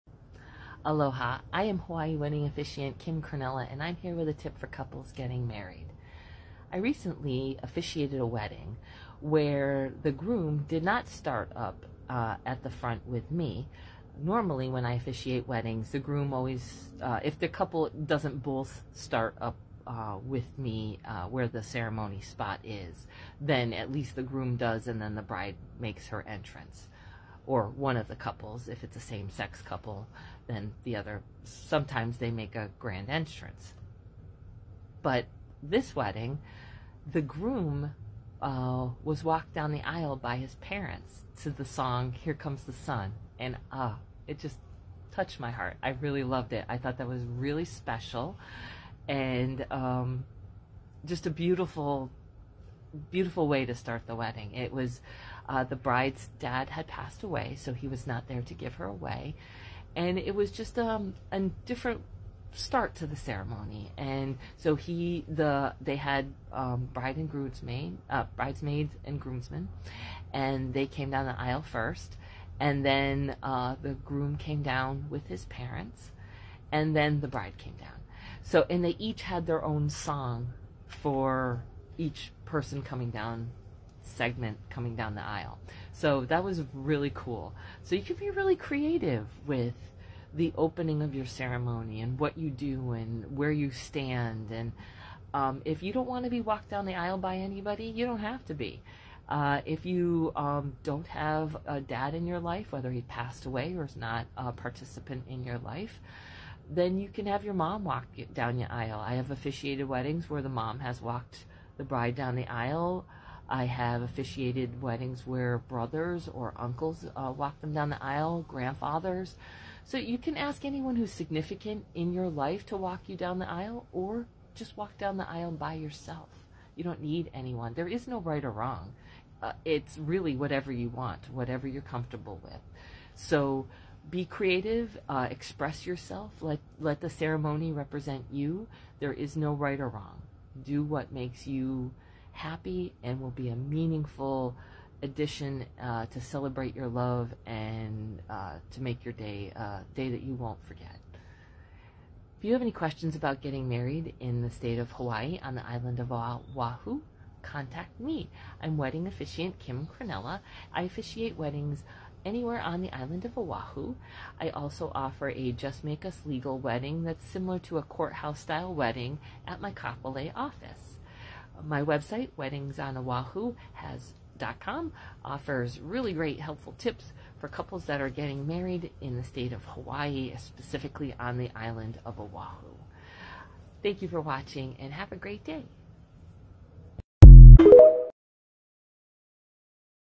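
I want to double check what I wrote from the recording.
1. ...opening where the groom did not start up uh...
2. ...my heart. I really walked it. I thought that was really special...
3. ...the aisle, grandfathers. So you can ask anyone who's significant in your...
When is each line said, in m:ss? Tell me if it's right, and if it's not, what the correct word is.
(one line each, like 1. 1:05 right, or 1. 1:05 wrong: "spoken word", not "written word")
1. 0:08 wrong: "wedding", not "opening"
2. 0:45 wrong: "loved", not "walked"
3. 1:57 right.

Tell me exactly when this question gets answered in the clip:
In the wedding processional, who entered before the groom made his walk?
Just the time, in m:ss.
1:08.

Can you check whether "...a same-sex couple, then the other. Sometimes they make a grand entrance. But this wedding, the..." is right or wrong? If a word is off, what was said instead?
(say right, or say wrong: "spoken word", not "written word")
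right.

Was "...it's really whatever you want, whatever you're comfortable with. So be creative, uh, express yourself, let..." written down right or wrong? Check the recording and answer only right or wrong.
right.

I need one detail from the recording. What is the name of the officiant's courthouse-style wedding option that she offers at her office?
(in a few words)
Just Make Us Legal.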